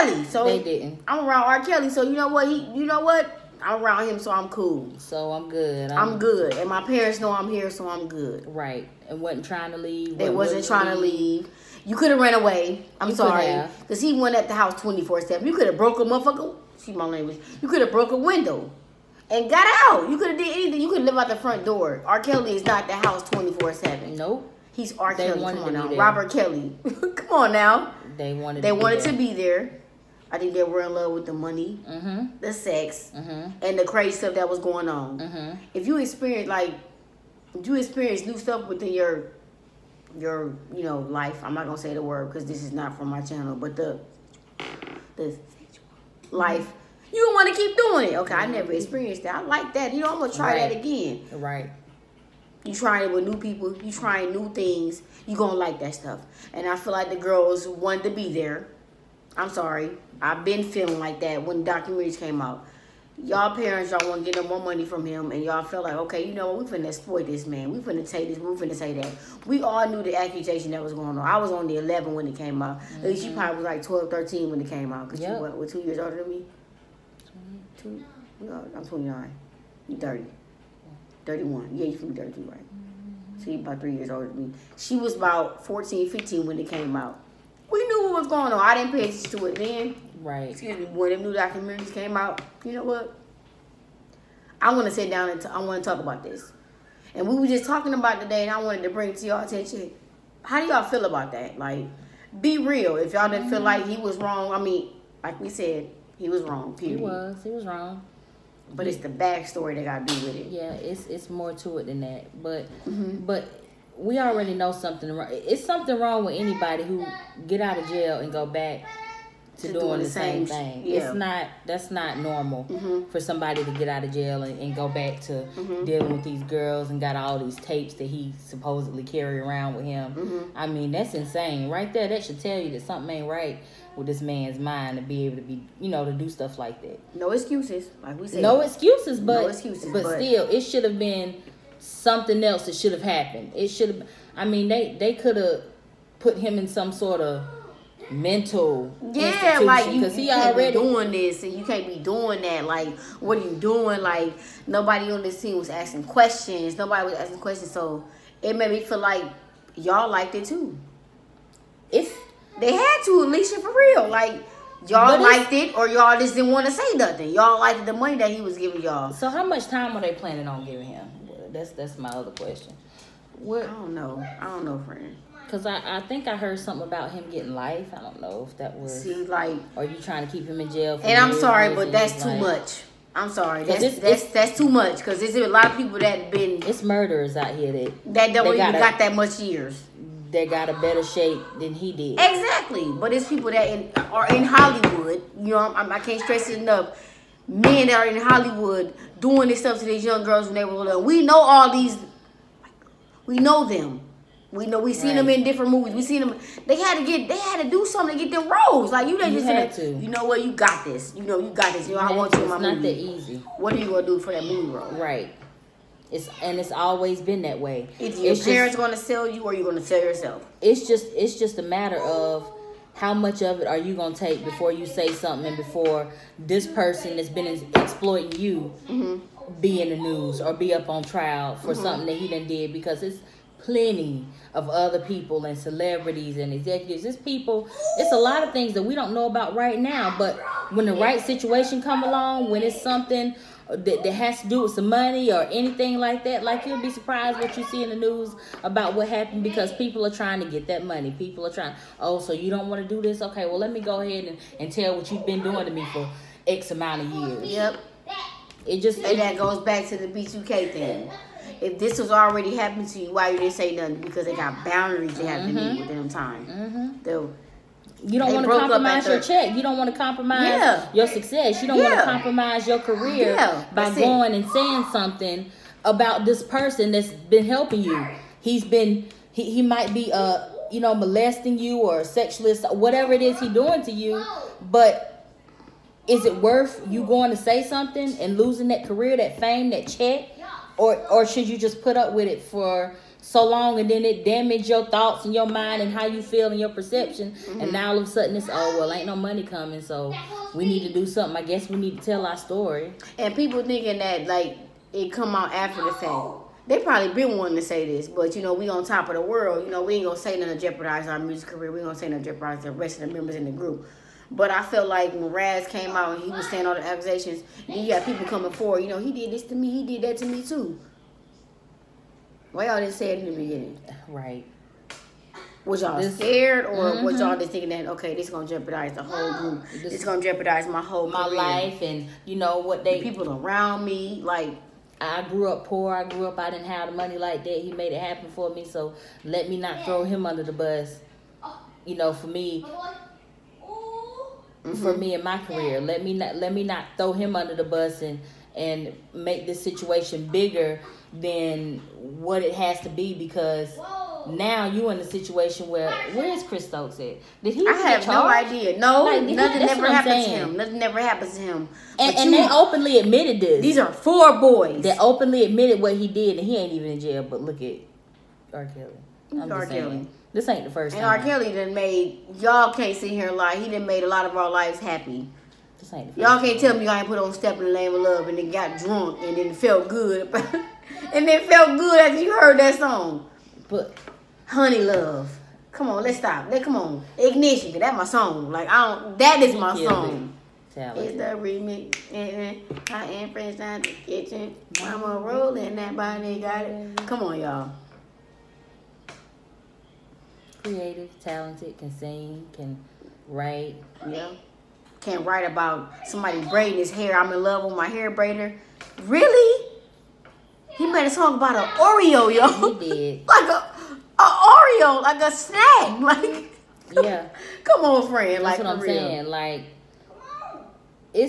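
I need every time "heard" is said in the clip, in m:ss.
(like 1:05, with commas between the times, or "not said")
2:56, 6:22.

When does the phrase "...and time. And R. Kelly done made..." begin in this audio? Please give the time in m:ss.
6:10.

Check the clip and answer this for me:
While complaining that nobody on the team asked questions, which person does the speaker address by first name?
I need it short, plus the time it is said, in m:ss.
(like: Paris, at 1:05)
Alicia, at 2:43.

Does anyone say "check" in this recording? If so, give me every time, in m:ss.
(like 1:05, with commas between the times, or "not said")
4:29, 4:49.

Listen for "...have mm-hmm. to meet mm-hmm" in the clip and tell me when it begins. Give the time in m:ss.
4:25.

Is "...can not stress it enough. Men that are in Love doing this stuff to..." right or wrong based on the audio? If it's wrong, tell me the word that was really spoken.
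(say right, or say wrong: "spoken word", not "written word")
wrong: "Hollywood", not "Love".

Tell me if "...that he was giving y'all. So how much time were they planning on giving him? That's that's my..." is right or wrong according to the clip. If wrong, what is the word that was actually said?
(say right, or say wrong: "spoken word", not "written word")
right.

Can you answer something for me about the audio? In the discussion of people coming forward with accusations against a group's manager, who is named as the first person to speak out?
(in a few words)
Raz.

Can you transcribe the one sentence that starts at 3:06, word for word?
It's murderers out here that that don't even got, got that much years that got a better shape than he did.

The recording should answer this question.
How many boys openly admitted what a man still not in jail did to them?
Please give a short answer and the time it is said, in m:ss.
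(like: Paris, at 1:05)
4, at 6:03.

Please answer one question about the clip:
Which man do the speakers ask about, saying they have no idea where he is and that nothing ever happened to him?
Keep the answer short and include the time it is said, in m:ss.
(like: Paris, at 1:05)
Chris Stokes, at 5:56.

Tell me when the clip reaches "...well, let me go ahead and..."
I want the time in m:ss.
4:13.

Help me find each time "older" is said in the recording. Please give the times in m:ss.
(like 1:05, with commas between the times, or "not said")
1:15, 1:24.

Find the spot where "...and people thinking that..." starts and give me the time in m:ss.
5:03.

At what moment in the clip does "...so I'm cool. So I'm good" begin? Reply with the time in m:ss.
0:04.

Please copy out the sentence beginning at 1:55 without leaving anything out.
It's something wrong with anybody who get out of jail and go back to, to doing, doing, the same, same thing.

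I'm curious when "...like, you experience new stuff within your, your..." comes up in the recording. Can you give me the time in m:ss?
0:36.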